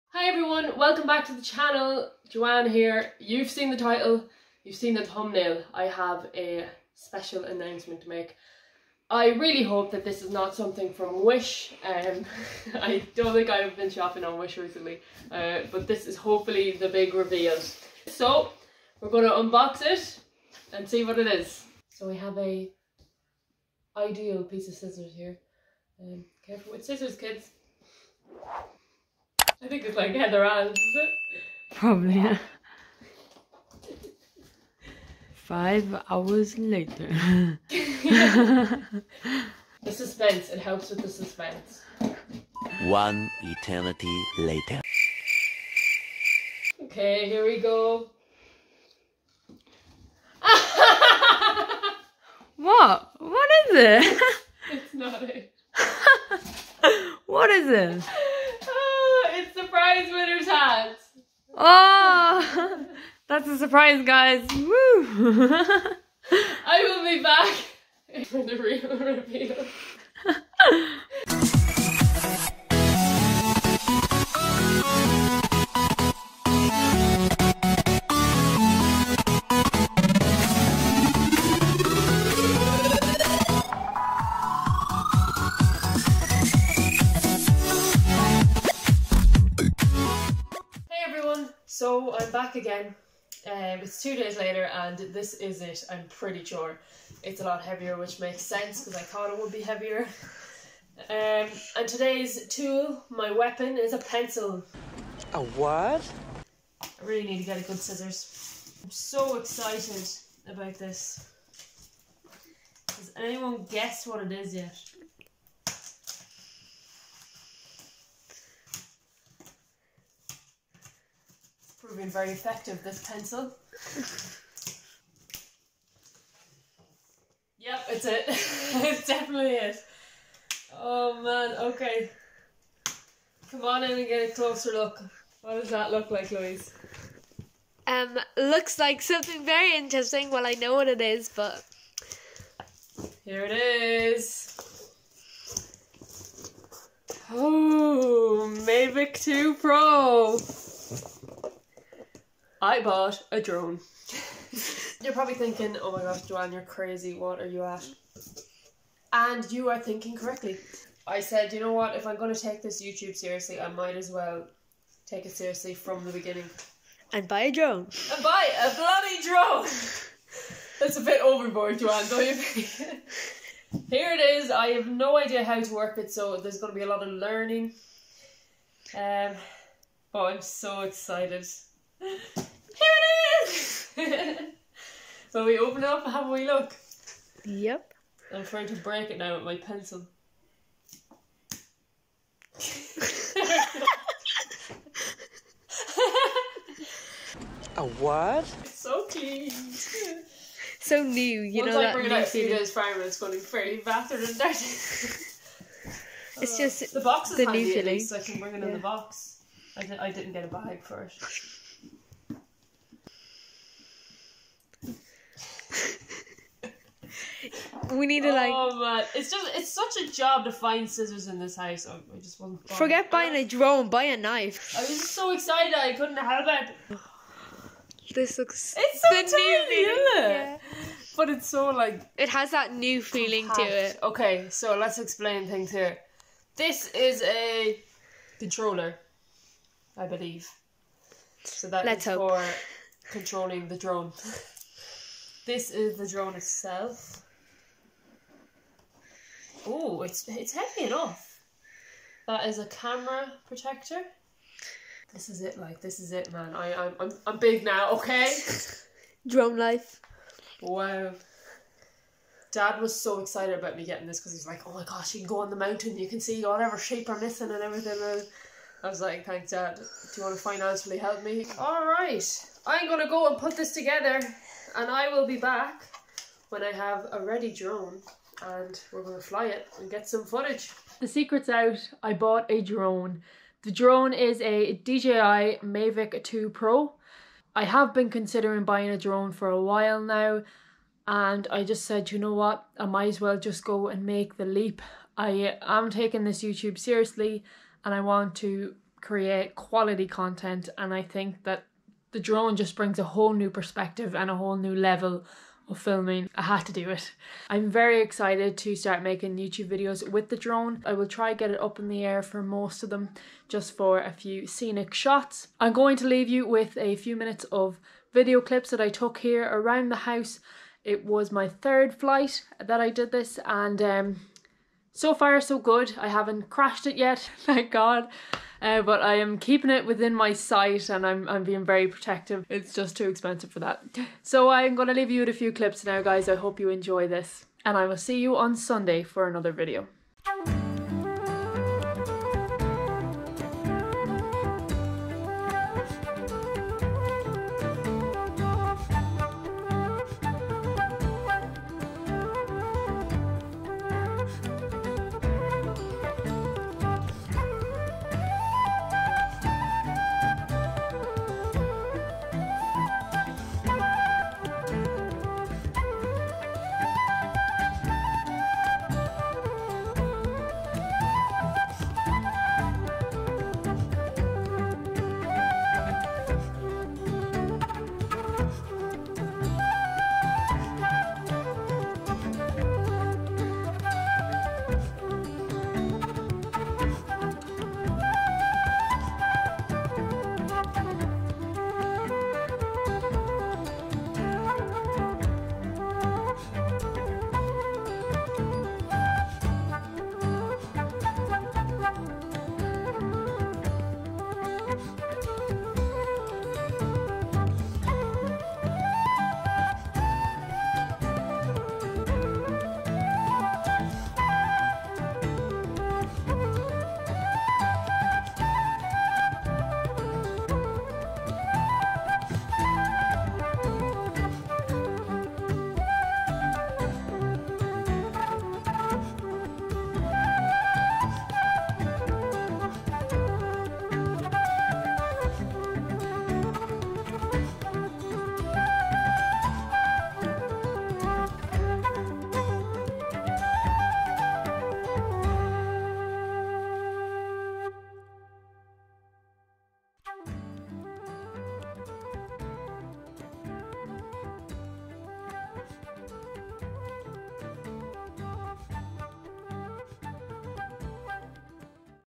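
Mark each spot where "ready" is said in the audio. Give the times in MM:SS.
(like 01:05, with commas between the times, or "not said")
04:37.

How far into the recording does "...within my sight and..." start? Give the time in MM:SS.
05:29.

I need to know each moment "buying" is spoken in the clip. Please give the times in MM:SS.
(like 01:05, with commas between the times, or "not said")
03:43, 04:48.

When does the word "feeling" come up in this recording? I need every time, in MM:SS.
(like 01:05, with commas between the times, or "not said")
03:27, 03:53.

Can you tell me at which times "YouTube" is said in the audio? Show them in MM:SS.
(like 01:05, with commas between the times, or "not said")
02:42, 04:56, 05:09.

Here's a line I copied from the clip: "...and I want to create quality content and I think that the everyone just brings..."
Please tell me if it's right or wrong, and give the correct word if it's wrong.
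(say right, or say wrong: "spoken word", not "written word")
wrong: "drone", not "everyone".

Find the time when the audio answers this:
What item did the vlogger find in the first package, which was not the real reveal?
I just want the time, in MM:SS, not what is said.
01:00.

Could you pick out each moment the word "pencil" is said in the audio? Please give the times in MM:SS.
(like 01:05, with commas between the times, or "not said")
01:43, 02:03, 03:09.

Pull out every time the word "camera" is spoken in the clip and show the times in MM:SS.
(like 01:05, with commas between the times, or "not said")
04:12.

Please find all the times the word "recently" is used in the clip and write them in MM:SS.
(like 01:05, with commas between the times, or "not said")
00:14.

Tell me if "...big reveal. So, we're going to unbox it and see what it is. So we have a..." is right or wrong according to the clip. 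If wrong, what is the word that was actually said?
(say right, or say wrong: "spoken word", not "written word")
right.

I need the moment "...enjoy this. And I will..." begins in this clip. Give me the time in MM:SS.
05:36.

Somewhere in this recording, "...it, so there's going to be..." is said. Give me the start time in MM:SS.
02:55.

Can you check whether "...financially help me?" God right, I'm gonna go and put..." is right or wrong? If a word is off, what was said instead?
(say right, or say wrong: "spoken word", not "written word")
wrong: "All", not "God".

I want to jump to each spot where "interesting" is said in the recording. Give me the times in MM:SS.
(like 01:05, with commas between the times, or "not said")
02:19.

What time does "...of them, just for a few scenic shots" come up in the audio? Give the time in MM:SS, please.
05:12.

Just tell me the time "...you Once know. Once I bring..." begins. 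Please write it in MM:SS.
03:21.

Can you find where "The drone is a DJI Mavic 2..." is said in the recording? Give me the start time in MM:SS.
04:43.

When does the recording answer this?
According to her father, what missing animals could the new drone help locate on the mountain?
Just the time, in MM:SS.
04:26.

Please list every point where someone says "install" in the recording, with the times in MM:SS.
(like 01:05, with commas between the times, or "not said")
not said.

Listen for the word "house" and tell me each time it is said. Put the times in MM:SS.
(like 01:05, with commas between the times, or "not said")
03:41, 05:19.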